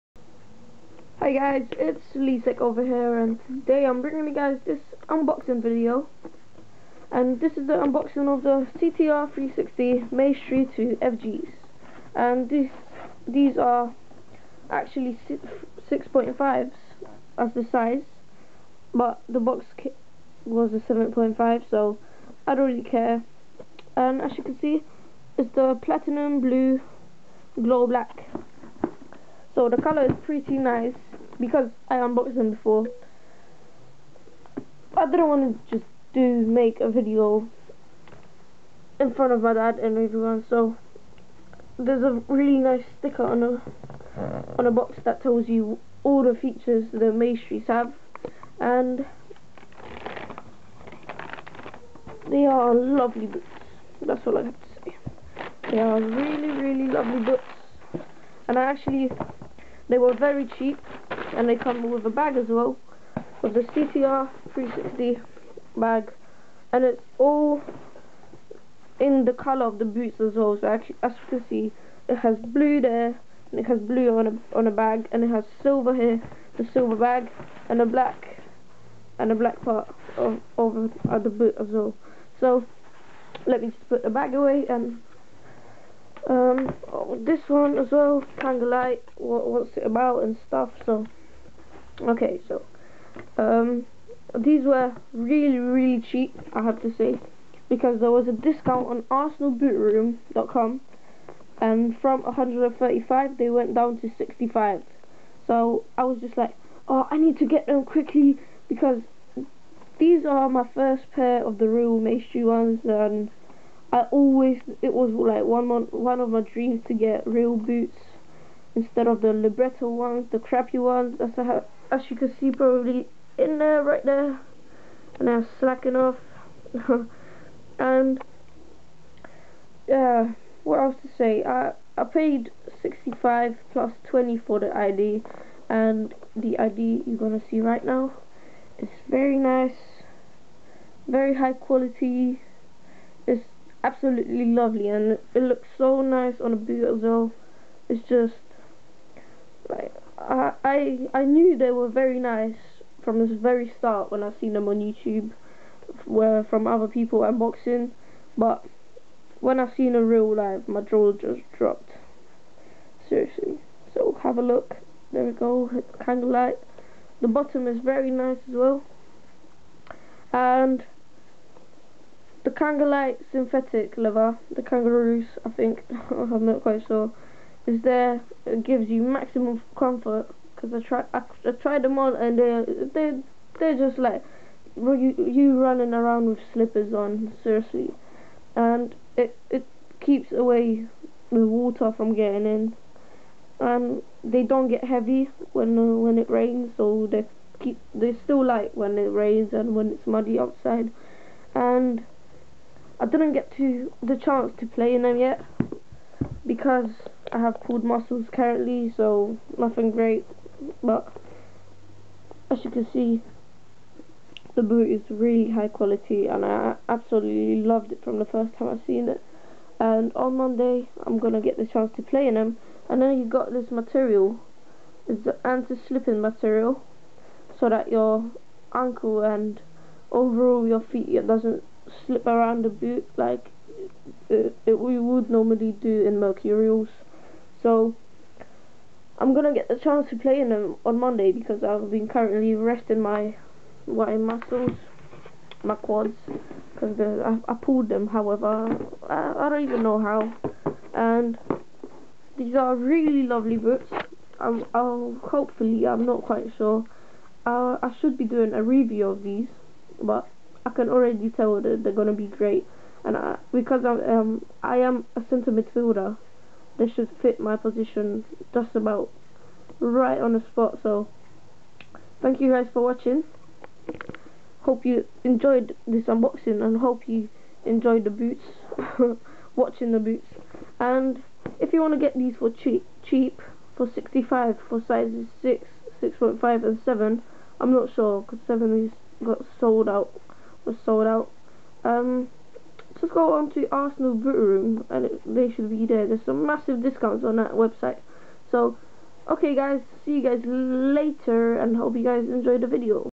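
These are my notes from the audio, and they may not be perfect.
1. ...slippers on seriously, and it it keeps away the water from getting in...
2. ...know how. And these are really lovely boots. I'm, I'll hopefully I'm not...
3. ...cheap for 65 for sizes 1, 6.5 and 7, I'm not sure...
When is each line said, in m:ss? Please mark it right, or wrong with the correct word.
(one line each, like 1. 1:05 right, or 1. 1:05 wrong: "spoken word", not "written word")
1. 3:06 right
2. 4:09 right
3. 4:43 wrong: "6", not "1".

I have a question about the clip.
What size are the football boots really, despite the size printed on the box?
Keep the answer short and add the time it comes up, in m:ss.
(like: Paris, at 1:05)
6.5, at 0:15.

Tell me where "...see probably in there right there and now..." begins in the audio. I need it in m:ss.
2:02.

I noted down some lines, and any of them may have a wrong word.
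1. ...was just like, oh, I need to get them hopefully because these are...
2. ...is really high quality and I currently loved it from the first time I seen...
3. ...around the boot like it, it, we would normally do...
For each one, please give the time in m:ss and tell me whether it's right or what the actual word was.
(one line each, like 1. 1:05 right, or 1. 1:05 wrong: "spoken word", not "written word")
1. 1:46 wrong: "quickly", not "hopefully"
2. 3:34 wrong: "absolutely", not "currently"
3. 3:52 right.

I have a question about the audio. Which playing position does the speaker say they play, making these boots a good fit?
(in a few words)
Centre midfielder.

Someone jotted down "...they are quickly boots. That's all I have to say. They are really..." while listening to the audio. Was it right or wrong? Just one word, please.
wrong.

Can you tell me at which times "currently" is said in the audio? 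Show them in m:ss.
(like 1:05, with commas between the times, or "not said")
3:28, 4:02.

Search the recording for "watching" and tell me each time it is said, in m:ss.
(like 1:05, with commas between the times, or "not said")
4:32, 4:39.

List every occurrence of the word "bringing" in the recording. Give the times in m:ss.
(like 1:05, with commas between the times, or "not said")
0:04.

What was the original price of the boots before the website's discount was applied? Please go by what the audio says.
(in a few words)
135.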